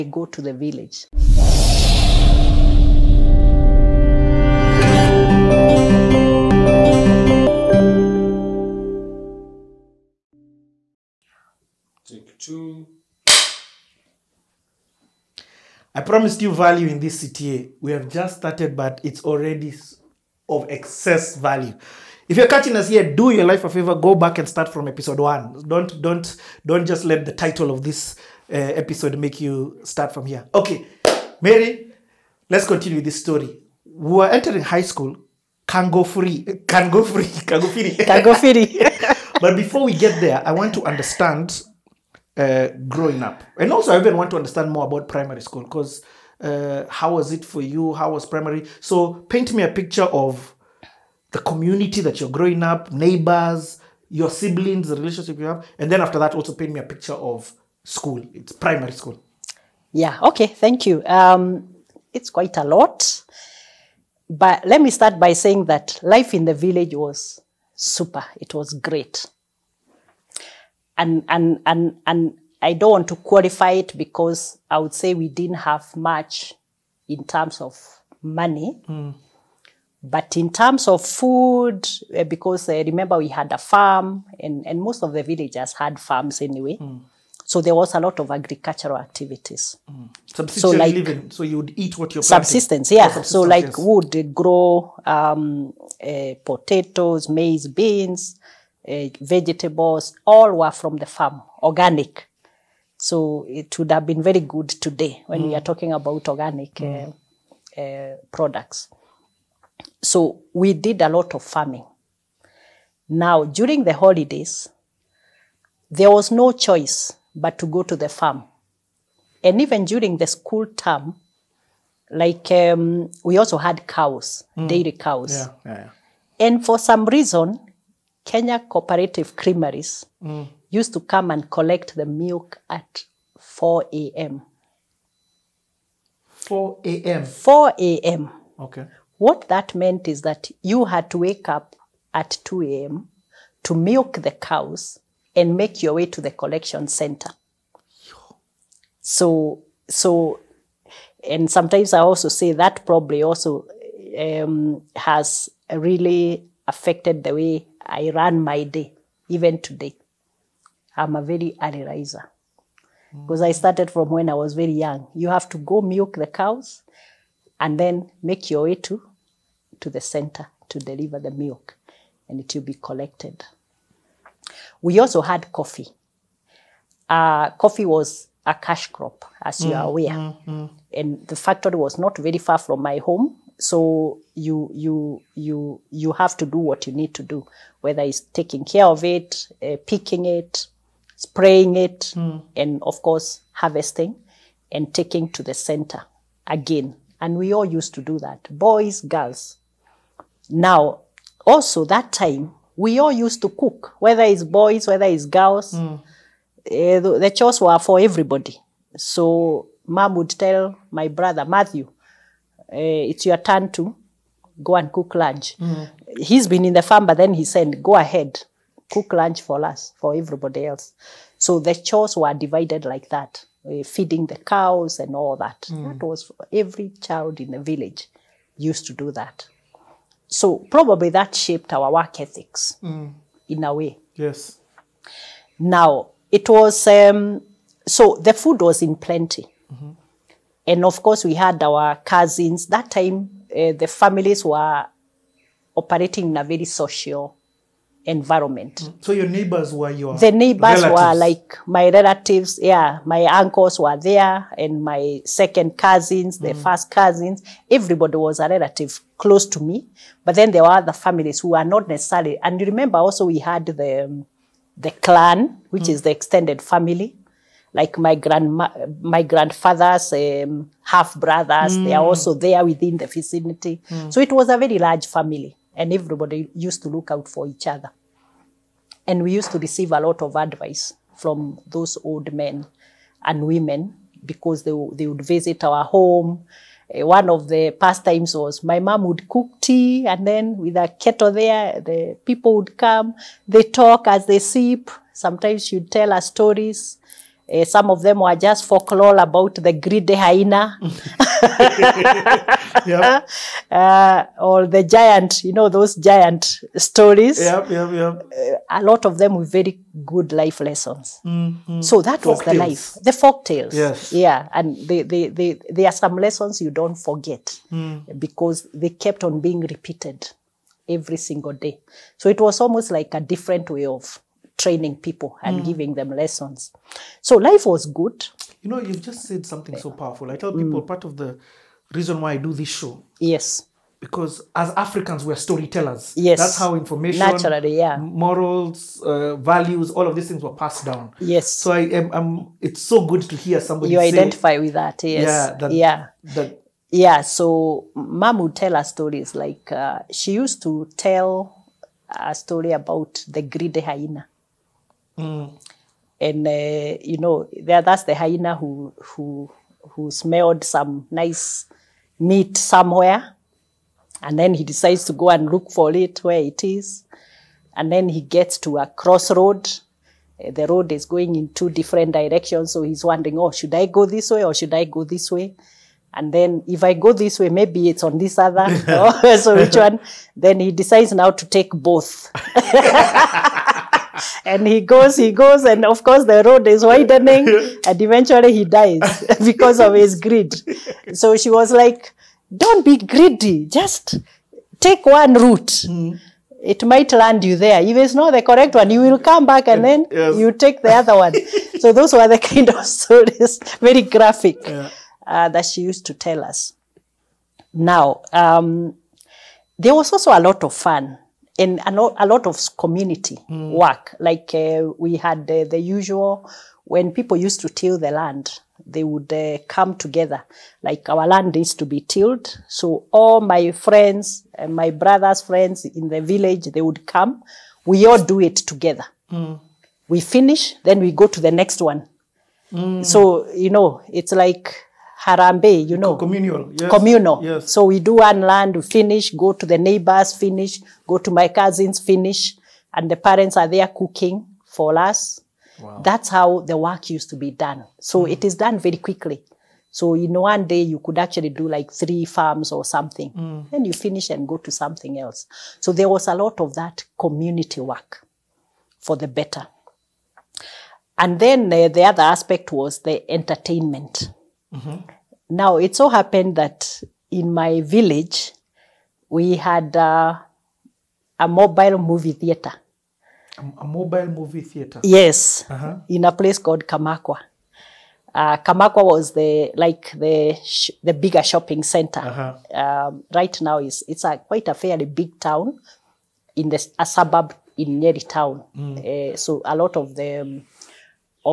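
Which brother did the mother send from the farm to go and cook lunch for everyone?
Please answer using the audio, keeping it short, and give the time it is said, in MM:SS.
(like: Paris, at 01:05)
Matthew, at 03:31.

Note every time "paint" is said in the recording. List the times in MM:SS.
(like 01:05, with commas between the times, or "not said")
00:49, 00:56.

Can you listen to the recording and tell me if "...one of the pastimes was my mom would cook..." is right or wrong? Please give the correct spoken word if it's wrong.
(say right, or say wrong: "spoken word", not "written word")
right.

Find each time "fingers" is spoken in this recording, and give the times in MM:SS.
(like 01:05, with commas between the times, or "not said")
not said.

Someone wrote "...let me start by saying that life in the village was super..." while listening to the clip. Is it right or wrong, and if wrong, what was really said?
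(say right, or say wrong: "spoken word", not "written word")
right.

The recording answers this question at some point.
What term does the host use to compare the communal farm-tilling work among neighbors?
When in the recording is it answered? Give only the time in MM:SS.
07:15.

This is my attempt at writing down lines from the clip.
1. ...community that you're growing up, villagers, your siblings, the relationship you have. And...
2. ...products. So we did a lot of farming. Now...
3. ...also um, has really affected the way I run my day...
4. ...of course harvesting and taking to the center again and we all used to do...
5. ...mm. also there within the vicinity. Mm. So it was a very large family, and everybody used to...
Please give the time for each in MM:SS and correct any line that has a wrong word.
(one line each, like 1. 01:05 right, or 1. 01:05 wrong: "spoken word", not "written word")
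1. 00:51 wrong: "neighbors", not "villagers"
2. 01:48 right
3. 02:33 right
4. 03:12 right
5. 04:32 right.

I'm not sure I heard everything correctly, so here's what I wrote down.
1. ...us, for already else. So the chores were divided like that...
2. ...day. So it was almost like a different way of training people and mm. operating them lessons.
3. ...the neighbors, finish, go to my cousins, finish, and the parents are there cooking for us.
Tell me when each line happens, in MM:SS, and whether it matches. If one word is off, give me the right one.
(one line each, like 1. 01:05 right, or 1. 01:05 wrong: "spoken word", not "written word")
1. 03:39 wrong: "everybody", not "already"
2. 05:21 wrong: "giving", not "operating"
3. 07:19 right.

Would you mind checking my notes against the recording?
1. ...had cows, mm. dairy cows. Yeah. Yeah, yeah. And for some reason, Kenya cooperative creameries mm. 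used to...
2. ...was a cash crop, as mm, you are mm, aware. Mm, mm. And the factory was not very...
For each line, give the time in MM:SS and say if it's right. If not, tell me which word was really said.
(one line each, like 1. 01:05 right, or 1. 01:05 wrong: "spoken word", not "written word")
1. 02:03 right
2. 02:57 right.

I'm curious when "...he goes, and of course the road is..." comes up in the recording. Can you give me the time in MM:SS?
06:25.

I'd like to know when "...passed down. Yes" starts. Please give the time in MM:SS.
05:40.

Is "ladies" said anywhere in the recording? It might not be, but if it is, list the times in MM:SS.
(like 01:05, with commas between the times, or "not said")
not said.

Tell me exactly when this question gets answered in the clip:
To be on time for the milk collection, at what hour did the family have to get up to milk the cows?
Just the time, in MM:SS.
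02:22.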